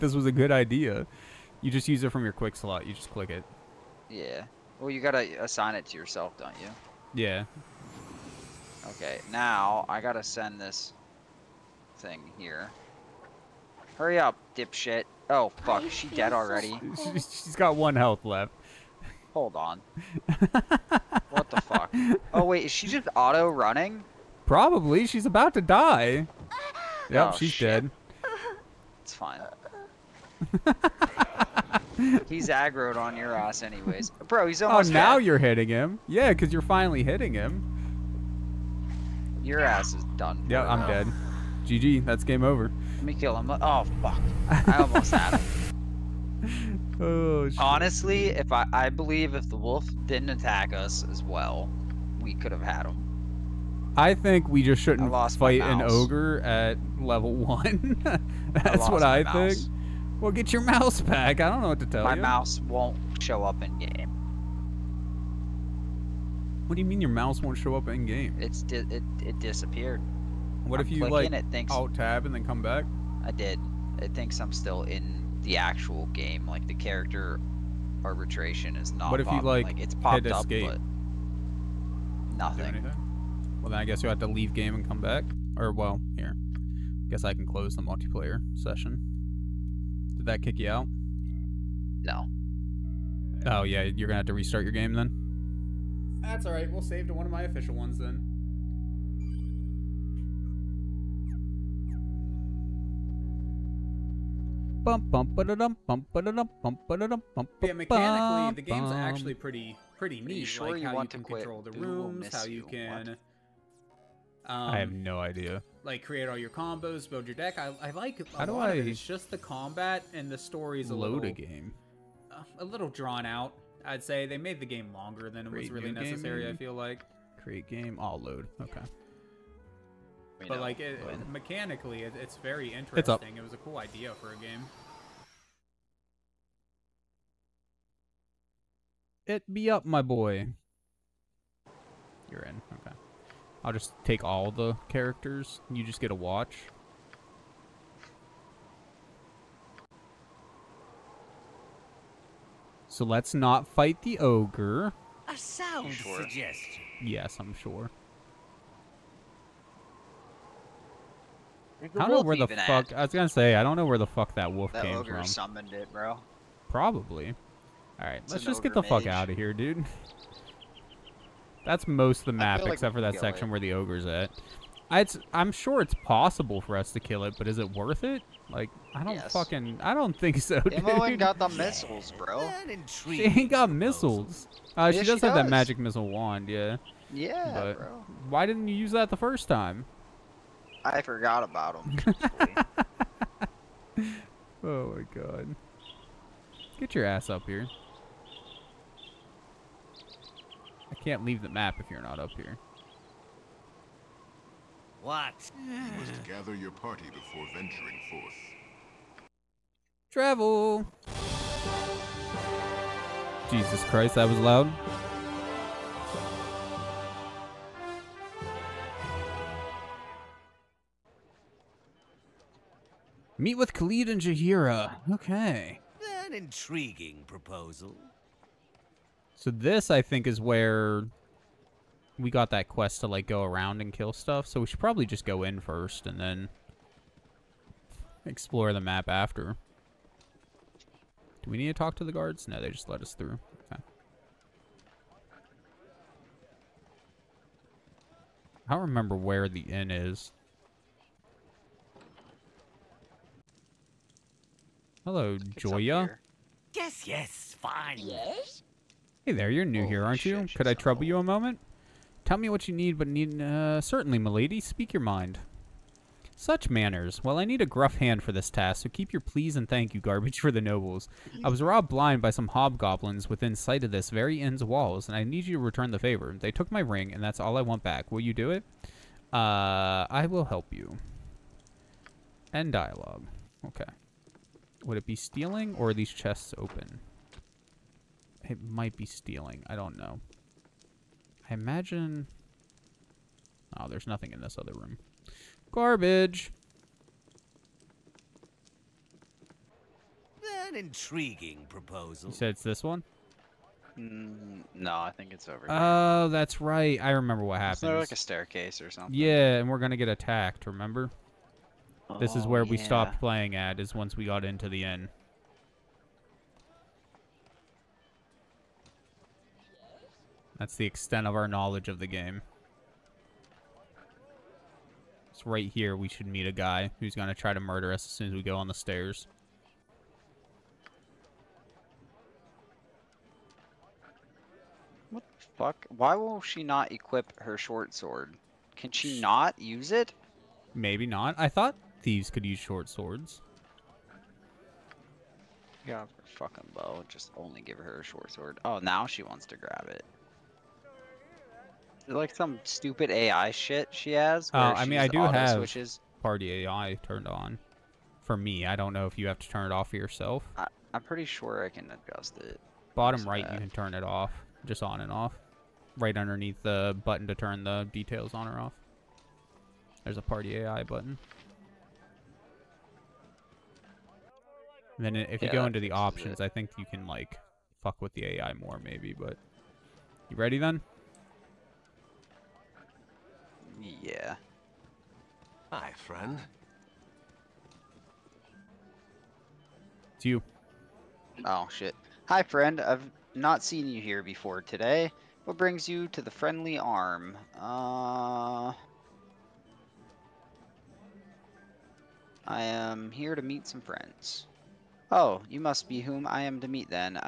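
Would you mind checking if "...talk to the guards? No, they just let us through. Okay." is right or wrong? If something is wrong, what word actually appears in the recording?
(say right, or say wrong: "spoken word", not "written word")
right.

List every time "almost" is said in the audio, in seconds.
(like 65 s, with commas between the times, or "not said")
34 s, 44 s.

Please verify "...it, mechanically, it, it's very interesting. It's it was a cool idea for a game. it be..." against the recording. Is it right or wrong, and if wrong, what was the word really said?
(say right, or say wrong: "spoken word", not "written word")
right.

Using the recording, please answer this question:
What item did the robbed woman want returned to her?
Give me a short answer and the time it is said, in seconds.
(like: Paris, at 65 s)
ring, at 276 s.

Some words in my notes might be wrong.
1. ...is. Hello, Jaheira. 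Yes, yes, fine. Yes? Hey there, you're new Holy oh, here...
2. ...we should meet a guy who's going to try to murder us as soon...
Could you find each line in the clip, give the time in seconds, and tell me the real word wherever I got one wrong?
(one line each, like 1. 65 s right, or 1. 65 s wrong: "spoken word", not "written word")
1. 249 s wrong: "Joia", not "Jaheira"
2. 325 s right.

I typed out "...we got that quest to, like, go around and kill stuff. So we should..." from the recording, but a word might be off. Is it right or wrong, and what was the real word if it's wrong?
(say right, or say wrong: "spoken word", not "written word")
right.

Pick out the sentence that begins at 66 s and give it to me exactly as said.
What do you mean your mouse won't show up in game?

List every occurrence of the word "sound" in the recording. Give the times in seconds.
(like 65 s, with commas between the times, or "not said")
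155 s.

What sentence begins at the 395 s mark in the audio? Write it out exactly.
What brings you to the friendly arm?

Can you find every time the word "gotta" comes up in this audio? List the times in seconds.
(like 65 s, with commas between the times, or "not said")
5 s, 10 s.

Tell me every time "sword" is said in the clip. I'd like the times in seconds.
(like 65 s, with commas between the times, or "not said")
337 s, 342 s, 348 s.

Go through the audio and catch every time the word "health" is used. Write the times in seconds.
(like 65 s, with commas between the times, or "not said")
17 s.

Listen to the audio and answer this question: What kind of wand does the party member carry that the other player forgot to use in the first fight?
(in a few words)
magic missile wand.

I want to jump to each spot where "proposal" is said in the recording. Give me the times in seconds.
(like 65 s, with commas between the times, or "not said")
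227 s, 301 s.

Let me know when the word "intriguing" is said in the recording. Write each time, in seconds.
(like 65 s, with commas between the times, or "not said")
226 s, 300 s.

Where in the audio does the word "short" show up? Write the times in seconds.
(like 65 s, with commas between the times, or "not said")
337 s, 342 s, 348 s.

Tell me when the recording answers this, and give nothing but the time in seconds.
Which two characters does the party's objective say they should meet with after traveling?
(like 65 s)
223 s.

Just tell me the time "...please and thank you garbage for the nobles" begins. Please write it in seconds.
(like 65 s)
269 s.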